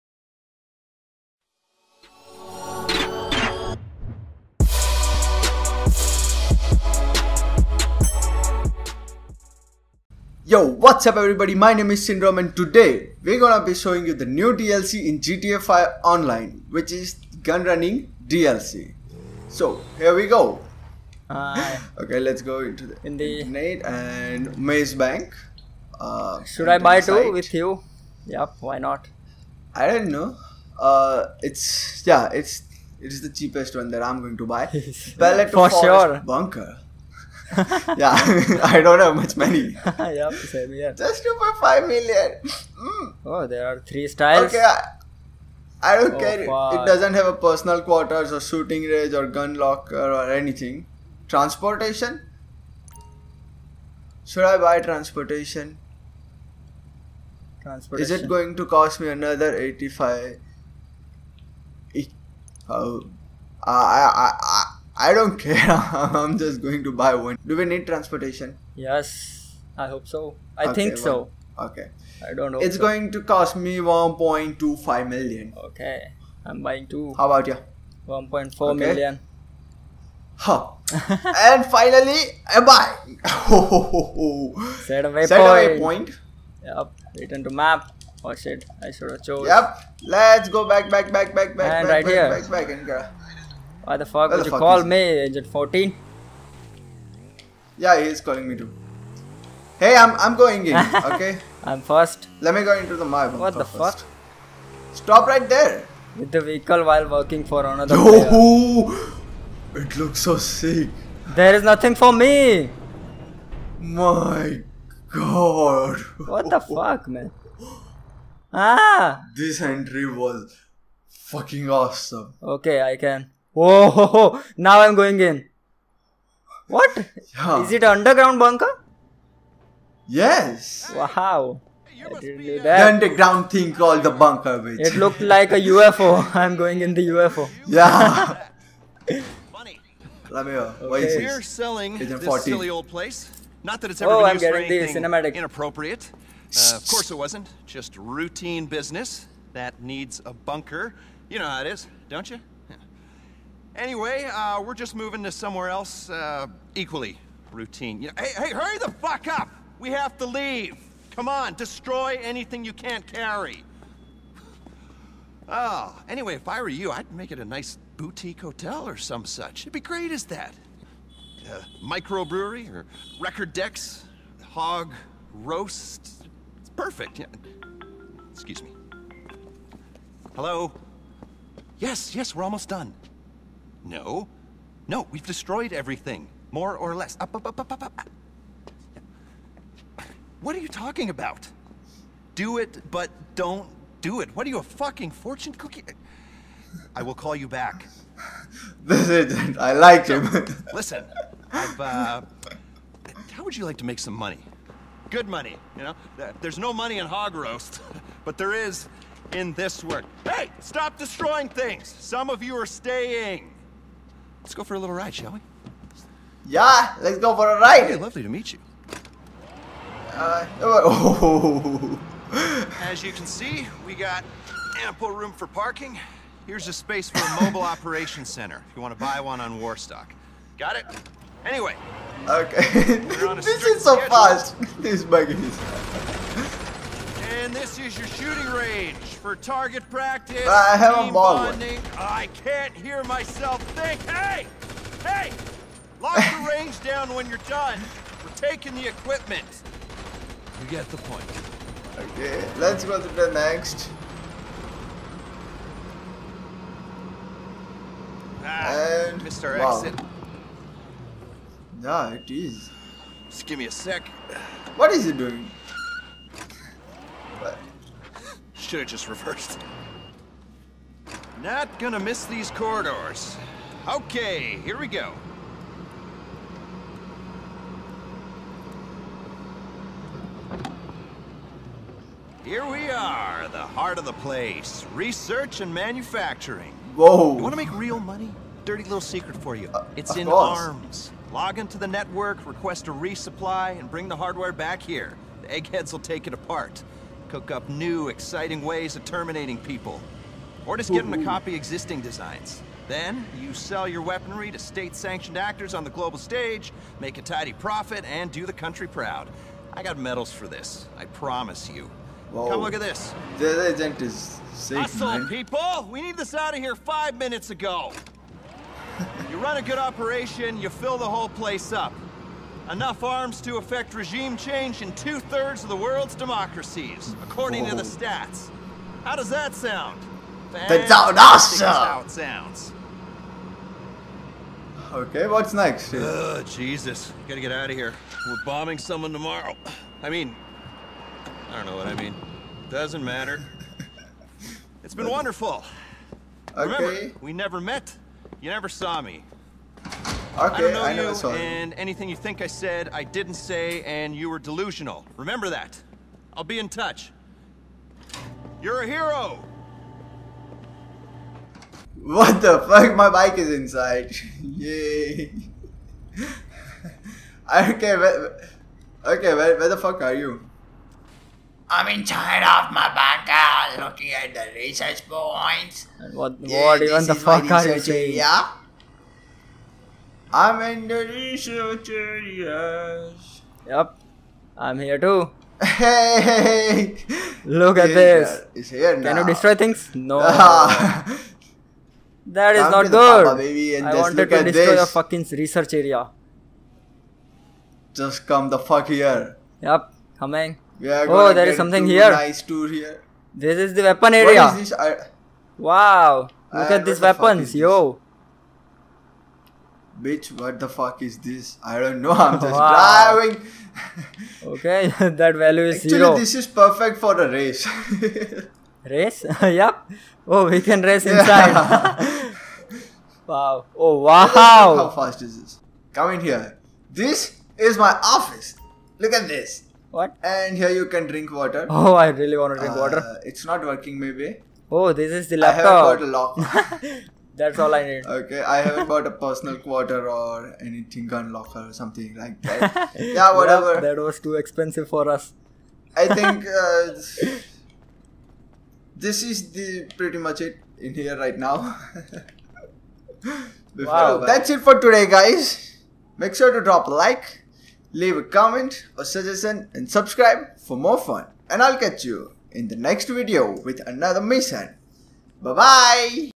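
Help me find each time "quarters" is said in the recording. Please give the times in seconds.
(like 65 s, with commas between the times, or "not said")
47 s, 439 s.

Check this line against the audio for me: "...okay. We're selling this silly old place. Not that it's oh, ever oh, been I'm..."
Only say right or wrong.
right.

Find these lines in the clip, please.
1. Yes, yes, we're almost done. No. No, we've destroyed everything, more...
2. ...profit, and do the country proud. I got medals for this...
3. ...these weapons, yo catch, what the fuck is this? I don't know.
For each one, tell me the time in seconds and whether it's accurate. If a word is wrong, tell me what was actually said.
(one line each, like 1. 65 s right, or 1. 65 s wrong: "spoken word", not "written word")
1. 181 s right
2. 307 s right
3. 406 s wrong: "bitch", not "catch".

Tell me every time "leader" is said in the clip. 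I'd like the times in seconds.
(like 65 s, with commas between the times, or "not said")
not said.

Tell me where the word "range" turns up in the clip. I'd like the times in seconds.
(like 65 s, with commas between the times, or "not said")
48 s, 238 s, 246 s.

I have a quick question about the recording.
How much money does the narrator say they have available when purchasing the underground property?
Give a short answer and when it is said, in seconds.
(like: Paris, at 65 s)
2.5 million, at 41 s.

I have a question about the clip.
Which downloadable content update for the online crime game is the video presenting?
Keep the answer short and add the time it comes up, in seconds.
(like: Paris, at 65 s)
Gun Running, at 17 s.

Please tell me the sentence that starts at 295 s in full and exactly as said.
The eggheads will take it apart cook up new, exciting ways of terminating people.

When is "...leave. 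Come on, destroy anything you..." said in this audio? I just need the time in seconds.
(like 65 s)
160 s.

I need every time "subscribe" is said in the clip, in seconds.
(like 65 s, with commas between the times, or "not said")
459 s.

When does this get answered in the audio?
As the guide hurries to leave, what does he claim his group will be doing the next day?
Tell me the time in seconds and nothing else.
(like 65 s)
338 s.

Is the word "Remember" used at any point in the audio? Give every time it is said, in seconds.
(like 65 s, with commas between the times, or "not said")
346 s, 355 s.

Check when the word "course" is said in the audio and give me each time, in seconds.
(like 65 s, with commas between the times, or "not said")
146 s, 290 s.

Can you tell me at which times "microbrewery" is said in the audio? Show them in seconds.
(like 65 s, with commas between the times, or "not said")
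171 s.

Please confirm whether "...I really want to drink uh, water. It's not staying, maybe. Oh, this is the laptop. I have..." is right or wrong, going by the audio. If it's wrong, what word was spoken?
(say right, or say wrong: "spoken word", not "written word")
wrong: "working", not "staying".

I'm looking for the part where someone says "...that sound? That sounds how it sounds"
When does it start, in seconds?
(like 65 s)
329 s.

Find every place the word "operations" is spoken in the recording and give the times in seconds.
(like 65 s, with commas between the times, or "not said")
227 s, 319 s.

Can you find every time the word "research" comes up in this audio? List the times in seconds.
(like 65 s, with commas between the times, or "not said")
284 s, 374 s, 381 s, 395 s.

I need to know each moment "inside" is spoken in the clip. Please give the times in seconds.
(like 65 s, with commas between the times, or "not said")
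363 s, 371 s, 421 s.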